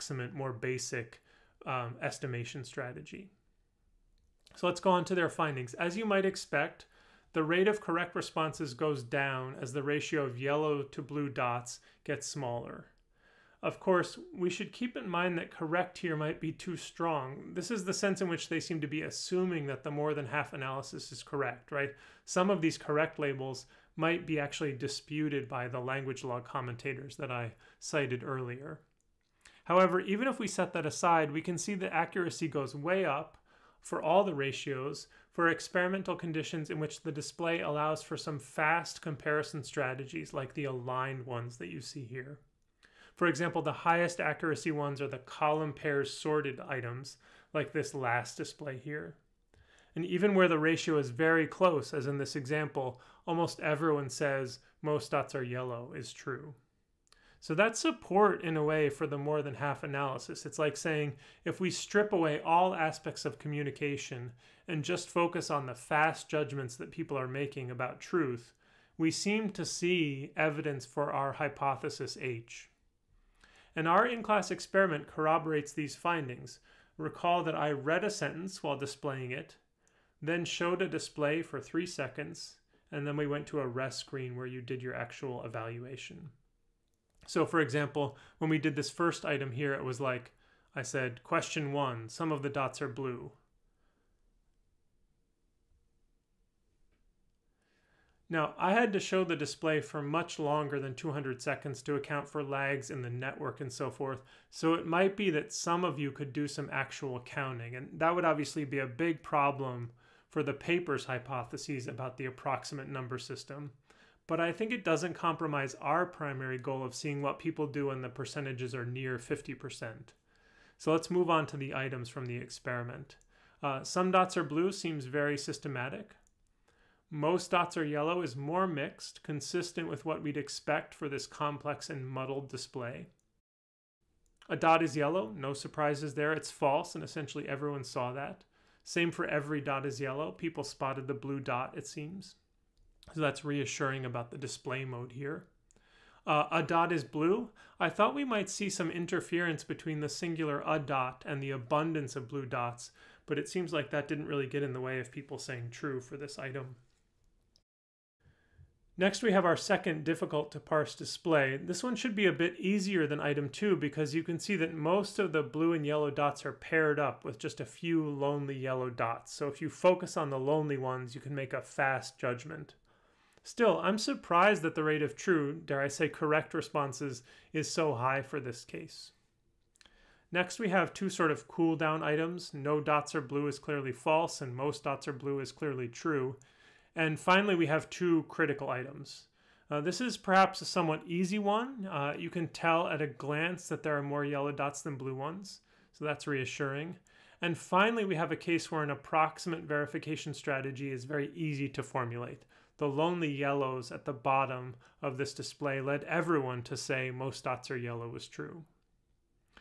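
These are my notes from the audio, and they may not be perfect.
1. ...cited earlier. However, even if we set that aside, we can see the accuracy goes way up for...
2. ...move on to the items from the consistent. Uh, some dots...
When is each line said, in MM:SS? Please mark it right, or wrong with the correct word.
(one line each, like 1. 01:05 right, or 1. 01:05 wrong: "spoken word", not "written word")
1. 00:27 right
2. 02:01 wrong: "experiment", not "consistent".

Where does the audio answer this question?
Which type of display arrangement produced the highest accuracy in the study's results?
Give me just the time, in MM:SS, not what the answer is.
00:45.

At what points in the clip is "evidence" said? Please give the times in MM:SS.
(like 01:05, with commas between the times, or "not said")
01:10.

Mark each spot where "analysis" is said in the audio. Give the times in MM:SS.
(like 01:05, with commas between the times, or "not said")
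00:20, 00:59.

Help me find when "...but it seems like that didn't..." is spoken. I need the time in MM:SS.
02:33.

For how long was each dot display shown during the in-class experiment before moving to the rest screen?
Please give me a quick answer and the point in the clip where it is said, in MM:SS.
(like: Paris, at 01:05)
3 seconds, at 01:21.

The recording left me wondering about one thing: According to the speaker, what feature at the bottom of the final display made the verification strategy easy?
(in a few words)
The lonely yellows.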